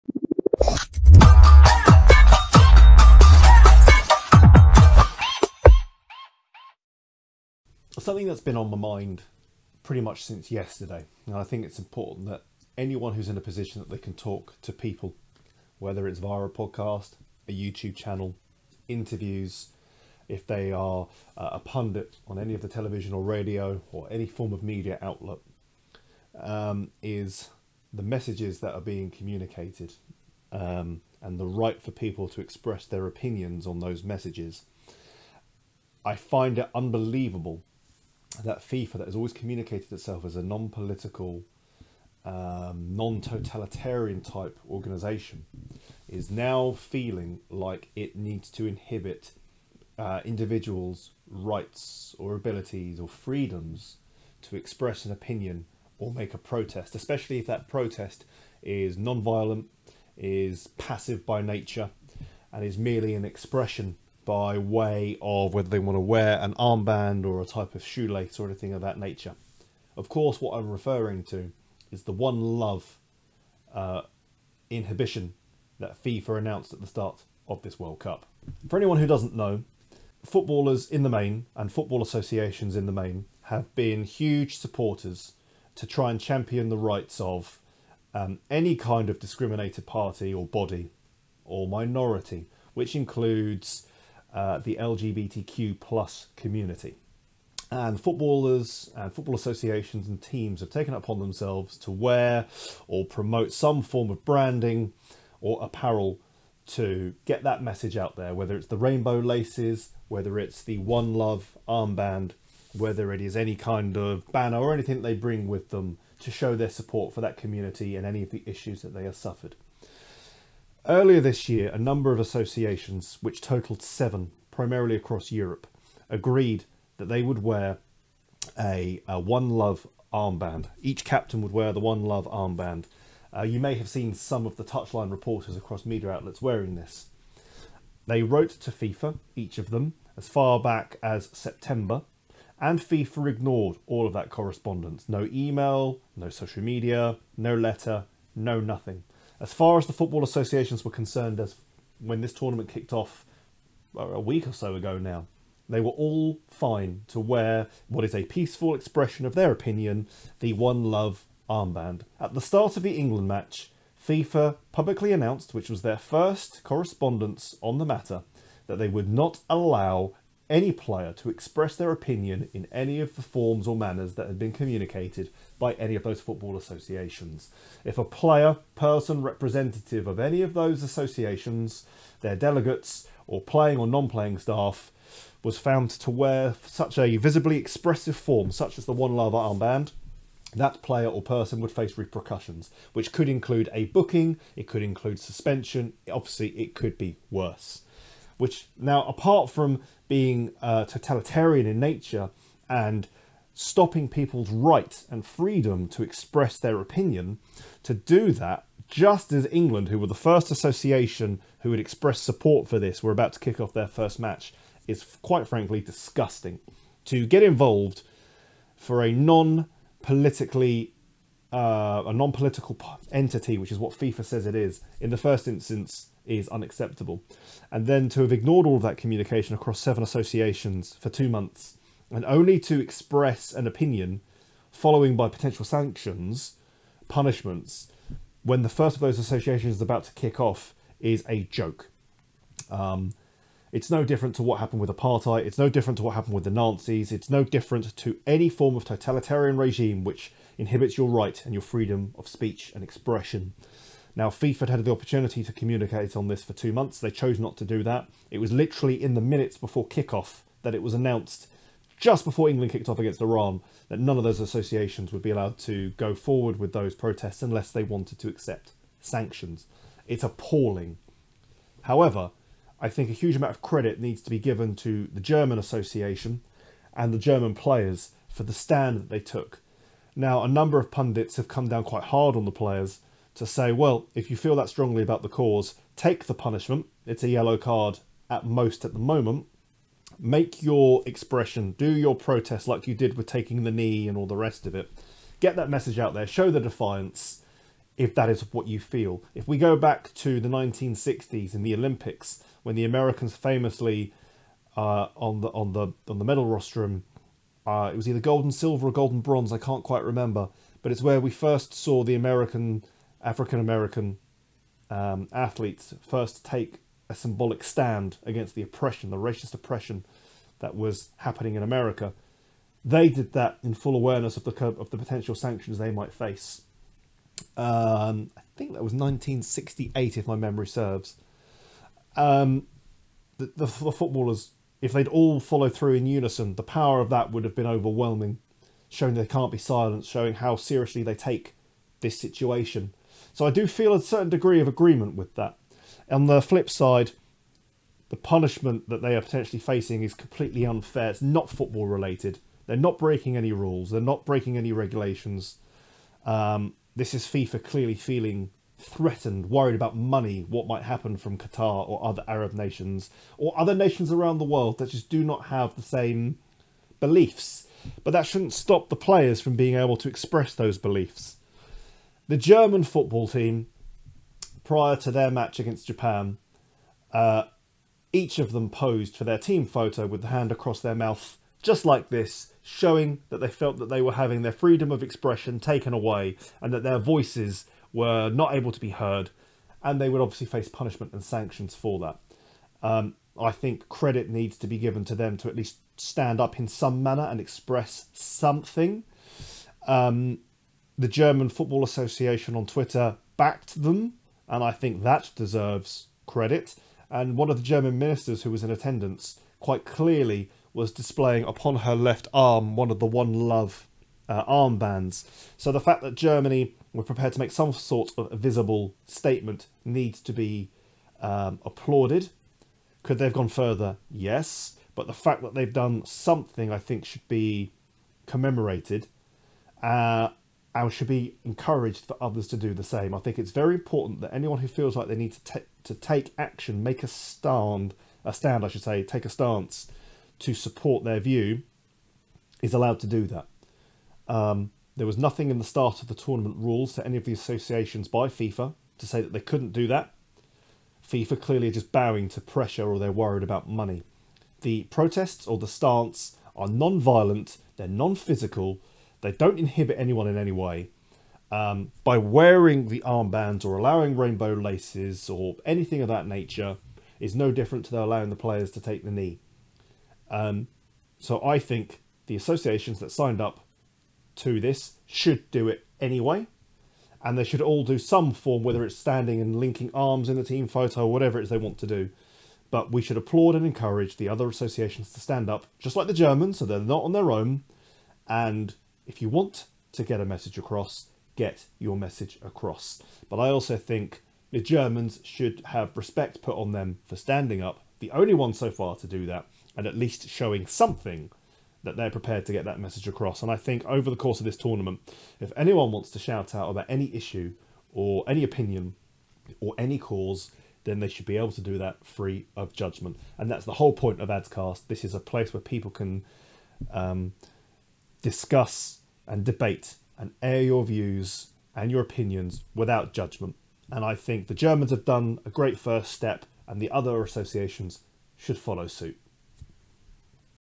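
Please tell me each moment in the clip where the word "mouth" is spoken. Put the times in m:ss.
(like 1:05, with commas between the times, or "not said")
6:20.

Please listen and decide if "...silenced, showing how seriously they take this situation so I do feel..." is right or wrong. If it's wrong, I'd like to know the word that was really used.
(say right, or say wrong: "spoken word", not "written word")
right.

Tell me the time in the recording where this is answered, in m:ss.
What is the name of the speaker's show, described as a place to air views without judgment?
8:34.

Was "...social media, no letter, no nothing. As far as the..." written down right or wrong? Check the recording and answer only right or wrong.
right.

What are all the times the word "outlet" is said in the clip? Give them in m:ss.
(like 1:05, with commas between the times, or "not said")
0:25, 2:16.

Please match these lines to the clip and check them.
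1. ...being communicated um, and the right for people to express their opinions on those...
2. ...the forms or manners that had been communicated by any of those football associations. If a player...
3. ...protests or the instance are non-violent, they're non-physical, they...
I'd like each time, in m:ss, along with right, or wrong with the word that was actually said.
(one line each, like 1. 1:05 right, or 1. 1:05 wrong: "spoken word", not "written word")
1. 0:28 right
2. 2:53 right
3. 7:34 wrong: "stance", not "instance".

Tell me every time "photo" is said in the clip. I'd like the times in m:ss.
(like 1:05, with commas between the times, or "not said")
6:19, 8:00.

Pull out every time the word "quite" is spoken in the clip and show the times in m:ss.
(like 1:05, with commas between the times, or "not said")
3:35, 4:41, 5:09, 6:49.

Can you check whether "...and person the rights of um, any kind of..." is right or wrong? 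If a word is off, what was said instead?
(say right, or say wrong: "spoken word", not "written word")
wrong: "champion", not "person".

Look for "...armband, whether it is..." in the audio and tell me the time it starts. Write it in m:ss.
1:51.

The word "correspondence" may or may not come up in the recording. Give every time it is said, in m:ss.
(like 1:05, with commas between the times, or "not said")
2:24, 2:46.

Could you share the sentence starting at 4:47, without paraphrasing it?
It's a yellow card at most at the moment.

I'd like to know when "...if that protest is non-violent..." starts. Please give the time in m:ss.
0:57.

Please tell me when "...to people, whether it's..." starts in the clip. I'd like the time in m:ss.
0:14.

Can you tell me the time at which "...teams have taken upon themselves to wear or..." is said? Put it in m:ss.
1:40.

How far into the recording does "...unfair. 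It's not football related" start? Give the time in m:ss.
5:50.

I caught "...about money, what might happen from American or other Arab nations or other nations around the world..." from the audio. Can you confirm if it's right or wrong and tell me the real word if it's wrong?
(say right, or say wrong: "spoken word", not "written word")
wrong: "Qatar", not "American".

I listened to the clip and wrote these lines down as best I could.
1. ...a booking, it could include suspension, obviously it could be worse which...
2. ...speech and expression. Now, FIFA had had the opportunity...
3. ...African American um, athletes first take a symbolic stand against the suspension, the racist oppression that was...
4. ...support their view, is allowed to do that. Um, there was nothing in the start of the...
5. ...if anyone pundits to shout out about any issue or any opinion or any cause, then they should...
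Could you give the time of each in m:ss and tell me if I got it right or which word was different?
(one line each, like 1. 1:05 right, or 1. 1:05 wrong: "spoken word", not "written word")
1. 3:13 right
2. 4:12 right
3. 5:13 wrong: "oppression", not "suspension"
4. 7:20 right
5. 8:25 wrong: "wants", not "pundits".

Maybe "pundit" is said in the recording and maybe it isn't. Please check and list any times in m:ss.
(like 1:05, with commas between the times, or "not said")
0:21, 4:40.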